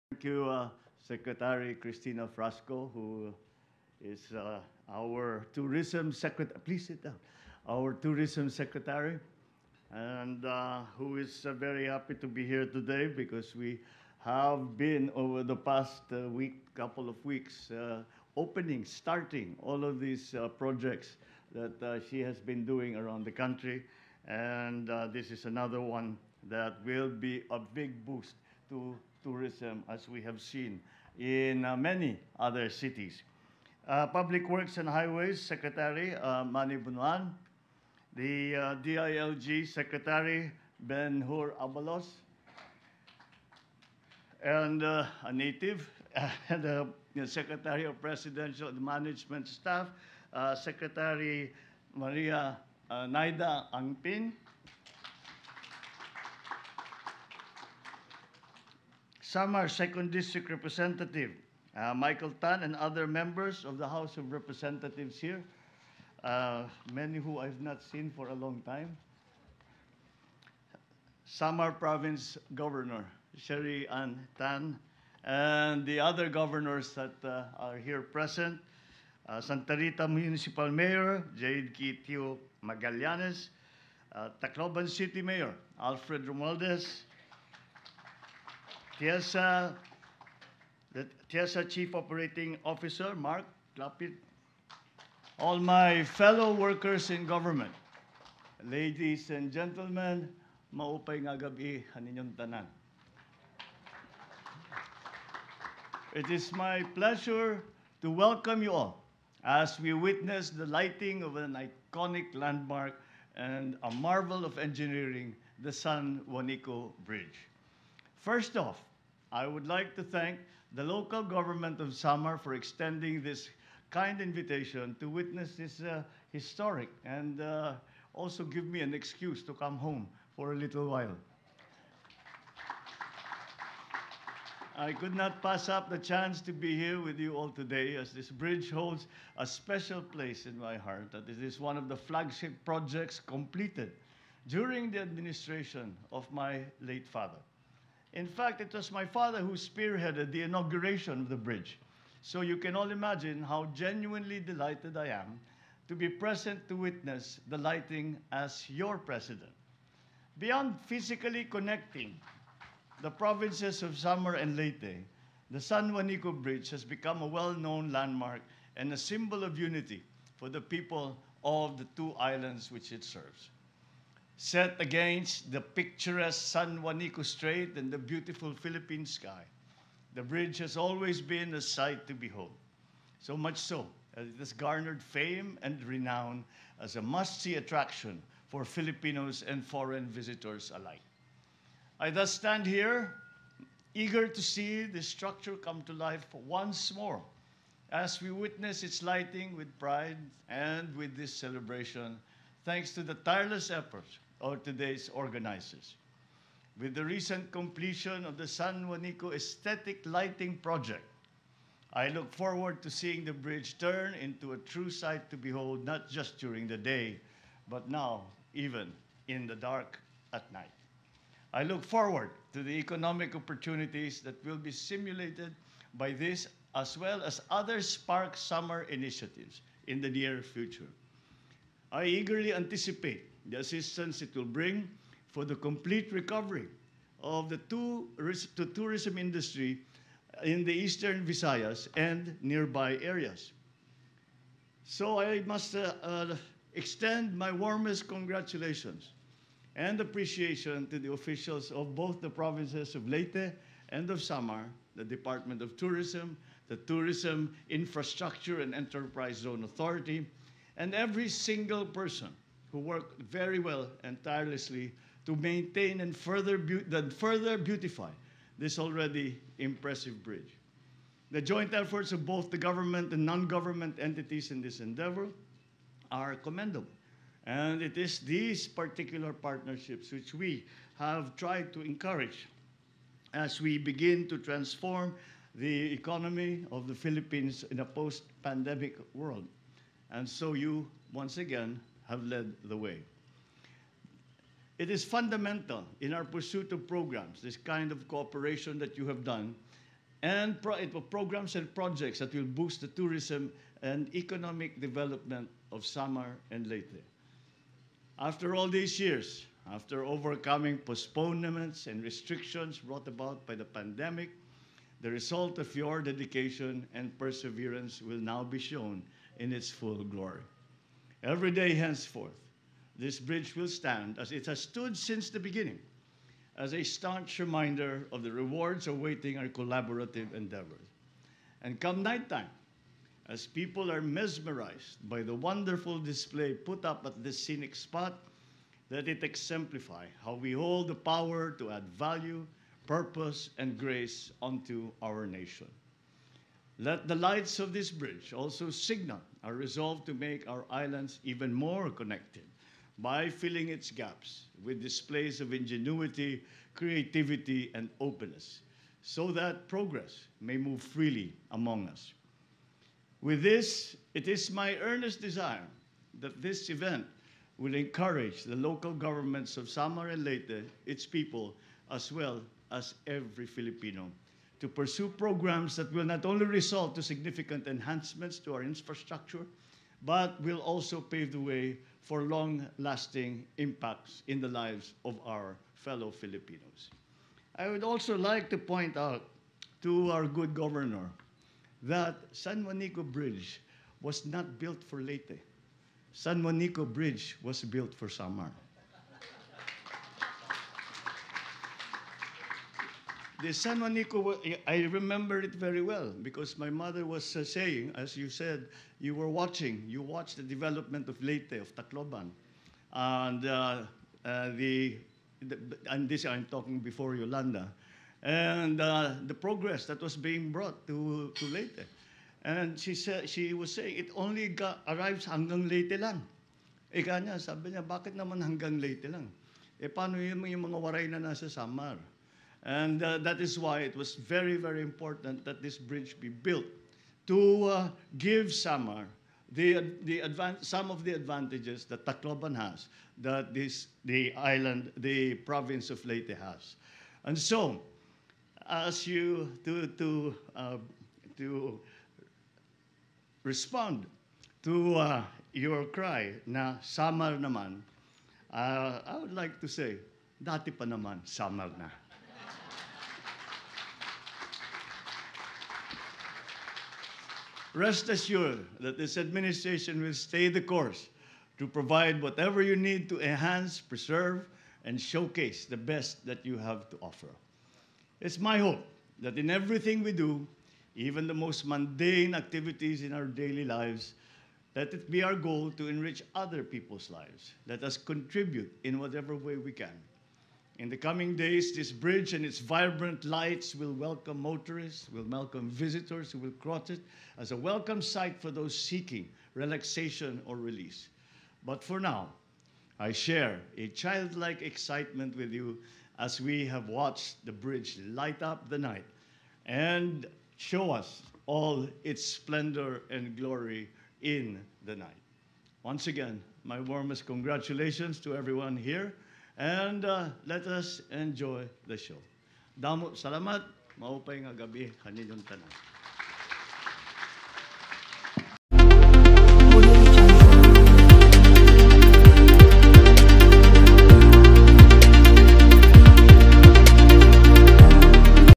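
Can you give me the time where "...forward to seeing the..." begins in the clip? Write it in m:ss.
3:32.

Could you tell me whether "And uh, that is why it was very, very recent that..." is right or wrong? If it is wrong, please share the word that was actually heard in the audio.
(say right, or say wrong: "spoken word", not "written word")
wrong: "important", not "recent".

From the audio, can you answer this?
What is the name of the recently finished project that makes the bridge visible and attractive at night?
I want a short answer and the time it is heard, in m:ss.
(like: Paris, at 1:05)
San Juanico Aesthetic Lighting Project, at 3:28.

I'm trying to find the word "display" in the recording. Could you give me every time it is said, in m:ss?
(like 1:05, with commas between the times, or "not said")
5:35, 5:54.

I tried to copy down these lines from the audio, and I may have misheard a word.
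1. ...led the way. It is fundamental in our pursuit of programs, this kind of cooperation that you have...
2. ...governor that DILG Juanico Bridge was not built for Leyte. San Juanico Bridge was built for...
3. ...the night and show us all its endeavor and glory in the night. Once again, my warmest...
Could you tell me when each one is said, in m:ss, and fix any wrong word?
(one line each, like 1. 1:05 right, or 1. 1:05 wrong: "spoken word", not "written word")
1. 4:52 right
2. 6:30 wrong: "San", not "DILG"
3. 8:28 wrong: "splendor", not "endeavor".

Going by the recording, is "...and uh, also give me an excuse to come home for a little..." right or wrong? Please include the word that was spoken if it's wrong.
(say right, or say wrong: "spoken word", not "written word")
right.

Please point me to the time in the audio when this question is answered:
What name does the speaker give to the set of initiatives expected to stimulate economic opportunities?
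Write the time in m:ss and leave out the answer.
3:47.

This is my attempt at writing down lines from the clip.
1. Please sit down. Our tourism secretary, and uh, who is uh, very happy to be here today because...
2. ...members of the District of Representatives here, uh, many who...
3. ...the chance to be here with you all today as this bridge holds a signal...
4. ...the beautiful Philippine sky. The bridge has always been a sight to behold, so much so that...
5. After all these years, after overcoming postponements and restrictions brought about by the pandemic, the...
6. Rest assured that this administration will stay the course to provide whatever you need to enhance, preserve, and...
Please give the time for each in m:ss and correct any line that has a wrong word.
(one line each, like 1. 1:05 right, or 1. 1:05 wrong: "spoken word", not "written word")
1. 0:06 right
2. 1:03 wrong: "House", not "District"
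3. 2:15 wrong: "special", not "signal"
4. 2:57 right
5. 5:08 right
6. 7:47 right.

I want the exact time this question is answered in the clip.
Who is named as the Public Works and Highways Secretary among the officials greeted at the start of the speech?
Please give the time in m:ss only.
0:36.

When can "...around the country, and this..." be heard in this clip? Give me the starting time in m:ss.
0:22.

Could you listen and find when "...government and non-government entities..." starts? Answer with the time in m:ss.
4:32.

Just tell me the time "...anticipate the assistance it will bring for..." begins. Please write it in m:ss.
3:52.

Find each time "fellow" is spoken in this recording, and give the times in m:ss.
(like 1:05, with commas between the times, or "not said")
1:36, 6:25.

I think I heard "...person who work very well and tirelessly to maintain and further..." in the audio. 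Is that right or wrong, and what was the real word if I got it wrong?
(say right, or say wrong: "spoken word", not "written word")
right.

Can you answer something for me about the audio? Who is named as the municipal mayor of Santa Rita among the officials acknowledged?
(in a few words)
Jade Kitio Magallanes.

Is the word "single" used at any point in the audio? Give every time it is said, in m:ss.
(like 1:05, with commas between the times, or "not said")
4:21.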